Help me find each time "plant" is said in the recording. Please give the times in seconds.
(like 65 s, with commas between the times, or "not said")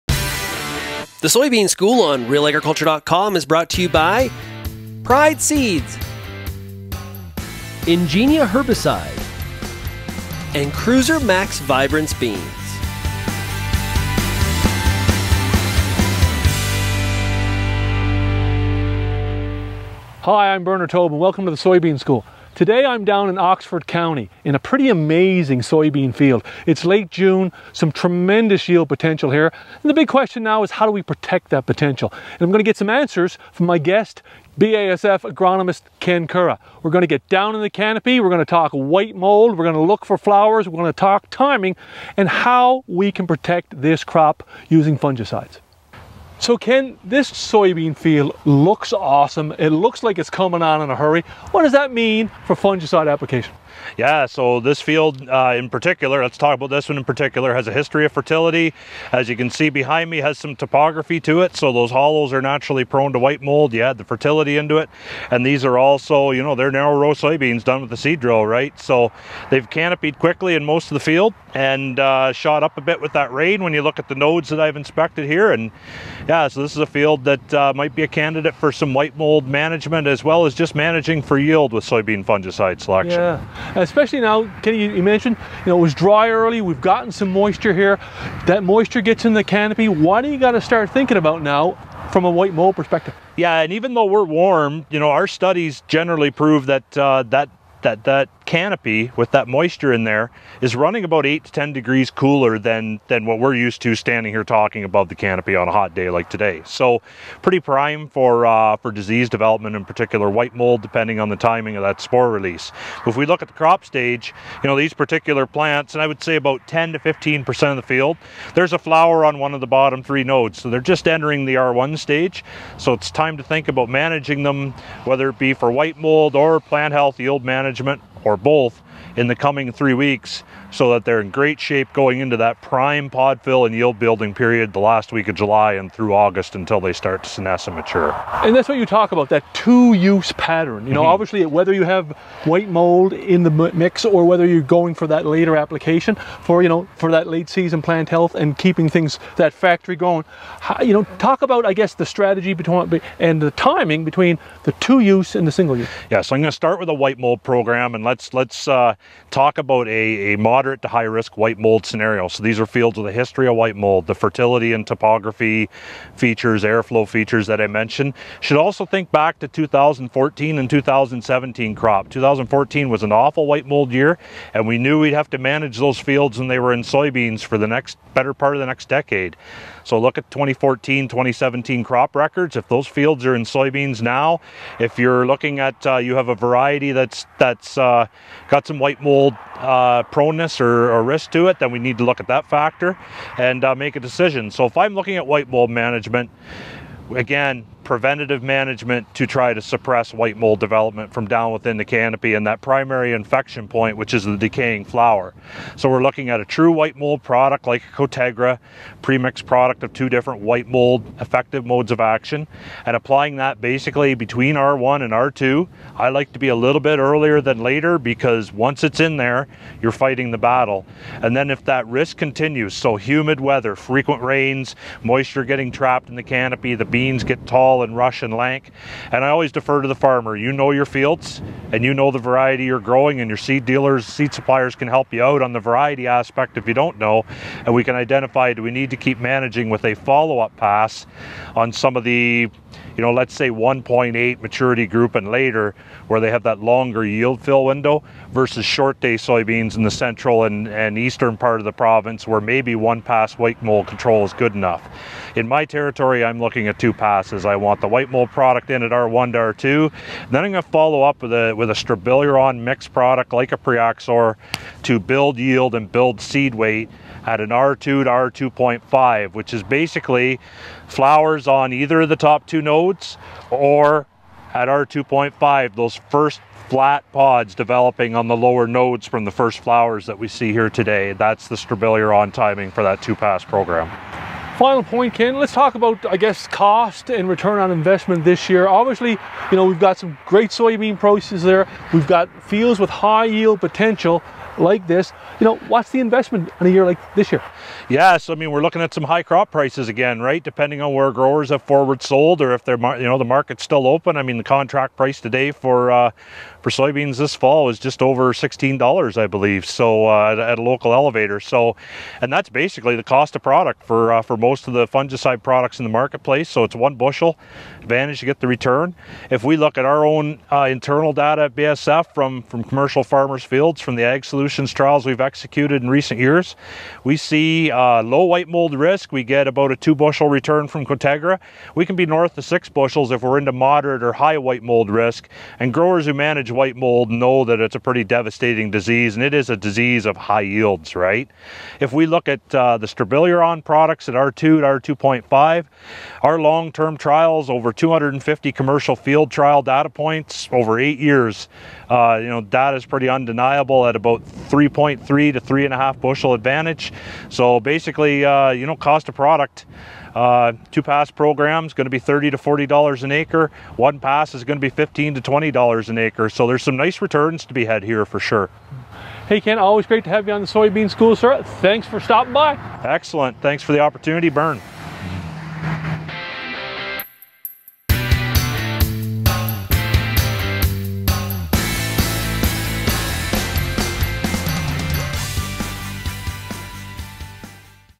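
115 s, 126 s, 147 s.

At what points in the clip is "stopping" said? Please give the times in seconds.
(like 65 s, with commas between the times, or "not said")
371 s.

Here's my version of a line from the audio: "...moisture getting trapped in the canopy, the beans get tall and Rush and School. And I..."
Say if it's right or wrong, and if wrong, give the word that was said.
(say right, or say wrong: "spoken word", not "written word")
wrong: "Lank", not "School".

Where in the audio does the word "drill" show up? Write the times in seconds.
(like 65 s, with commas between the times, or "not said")
68 s.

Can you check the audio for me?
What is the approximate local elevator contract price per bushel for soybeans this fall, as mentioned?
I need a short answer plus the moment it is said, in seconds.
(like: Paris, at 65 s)
just over $16, at 307 s.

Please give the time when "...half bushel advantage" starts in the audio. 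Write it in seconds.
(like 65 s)
355 s.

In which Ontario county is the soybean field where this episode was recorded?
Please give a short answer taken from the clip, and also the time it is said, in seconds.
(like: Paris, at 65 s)
Oxford County, at 23 s.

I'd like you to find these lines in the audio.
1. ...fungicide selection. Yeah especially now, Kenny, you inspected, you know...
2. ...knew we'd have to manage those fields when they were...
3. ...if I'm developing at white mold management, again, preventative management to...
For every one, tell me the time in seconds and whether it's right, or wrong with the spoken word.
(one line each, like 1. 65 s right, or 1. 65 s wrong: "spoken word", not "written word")
1. 82 s wrong: "mentioned", not "inspected"
2. 174 s right
3. 194 s wrong: "looking", not "developing".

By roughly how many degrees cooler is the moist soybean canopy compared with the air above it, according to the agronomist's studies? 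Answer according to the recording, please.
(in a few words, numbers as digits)
8 to 10 degrees.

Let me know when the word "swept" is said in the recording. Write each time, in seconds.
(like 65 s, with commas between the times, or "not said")
not said.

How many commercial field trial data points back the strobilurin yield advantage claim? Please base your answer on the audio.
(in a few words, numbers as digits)
over 250.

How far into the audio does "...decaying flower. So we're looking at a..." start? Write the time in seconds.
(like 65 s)
204 s.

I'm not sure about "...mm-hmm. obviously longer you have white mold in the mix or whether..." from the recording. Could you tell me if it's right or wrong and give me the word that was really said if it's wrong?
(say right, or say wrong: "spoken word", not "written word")
wrong: "whether", not "longer".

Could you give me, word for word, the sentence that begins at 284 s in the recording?
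Final point, Ken, let's talk about, I guess, cost and return on investment this year.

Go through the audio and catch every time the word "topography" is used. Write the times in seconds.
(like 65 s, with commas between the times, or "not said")
60 s, 164 s.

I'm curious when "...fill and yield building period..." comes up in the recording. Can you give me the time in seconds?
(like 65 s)
133 s.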